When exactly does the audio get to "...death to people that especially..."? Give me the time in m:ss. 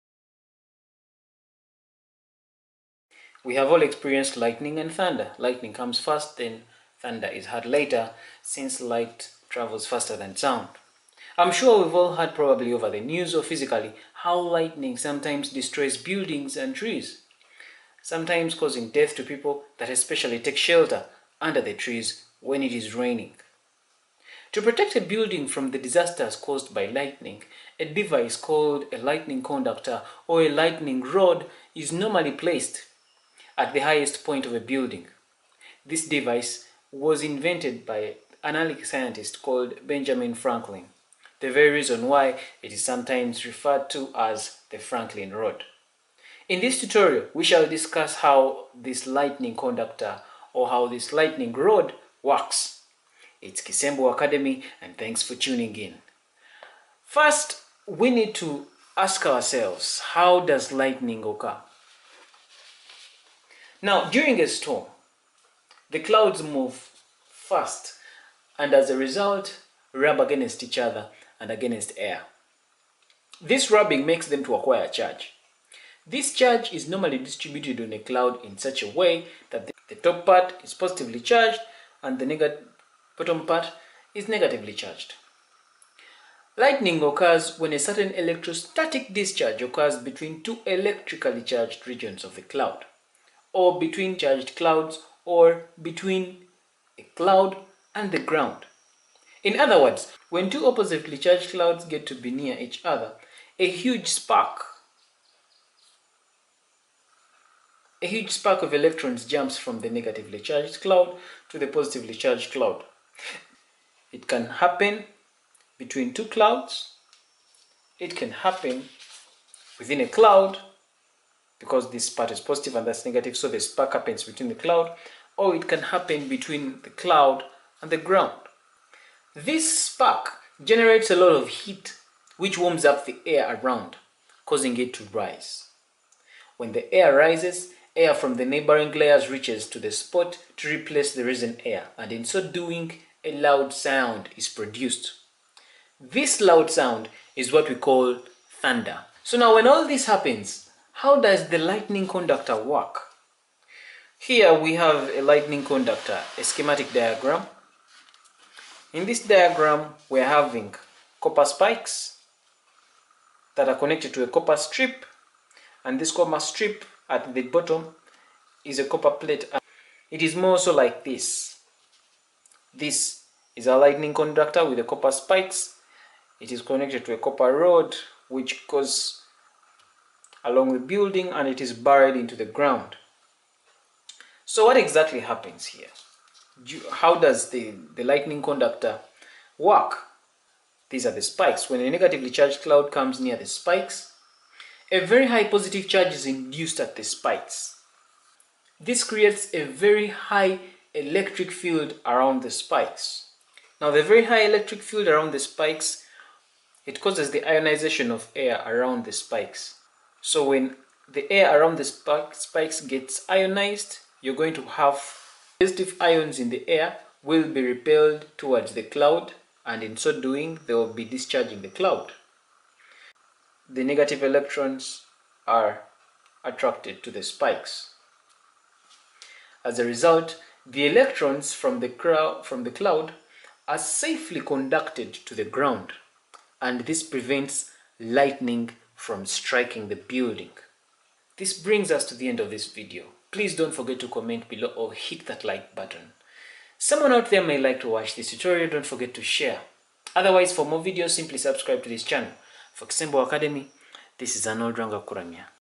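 0:18.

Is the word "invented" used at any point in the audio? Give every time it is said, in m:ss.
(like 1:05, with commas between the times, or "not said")
0:37.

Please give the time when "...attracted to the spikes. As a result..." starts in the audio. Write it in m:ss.
3:46.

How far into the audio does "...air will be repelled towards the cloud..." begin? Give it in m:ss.
3:36.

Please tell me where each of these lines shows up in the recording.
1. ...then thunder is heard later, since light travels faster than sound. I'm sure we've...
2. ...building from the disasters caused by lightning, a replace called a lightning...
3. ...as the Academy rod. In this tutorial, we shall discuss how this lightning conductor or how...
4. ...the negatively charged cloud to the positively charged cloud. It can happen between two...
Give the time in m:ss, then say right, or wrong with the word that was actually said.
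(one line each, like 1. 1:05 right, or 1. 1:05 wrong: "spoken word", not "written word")
1. 0:06 right
2. 0:25 wrong: "device", not "replace"
3. 0:44 wrong: "Franklin", not "Academy"
4. 1:49 right.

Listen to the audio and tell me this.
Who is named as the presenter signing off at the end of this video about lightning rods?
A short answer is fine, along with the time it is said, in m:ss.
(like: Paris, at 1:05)
Arnold Ranga Kuramia, at 4:14.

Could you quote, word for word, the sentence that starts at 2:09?
This spark generates a lot of heat which warms up the air around, causing it to rise.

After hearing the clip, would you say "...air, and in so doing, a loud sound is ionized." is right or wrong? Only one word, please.
wrong.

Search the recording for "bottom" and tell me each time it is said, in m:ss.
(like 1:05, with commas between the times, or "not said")
1:23, 2:47.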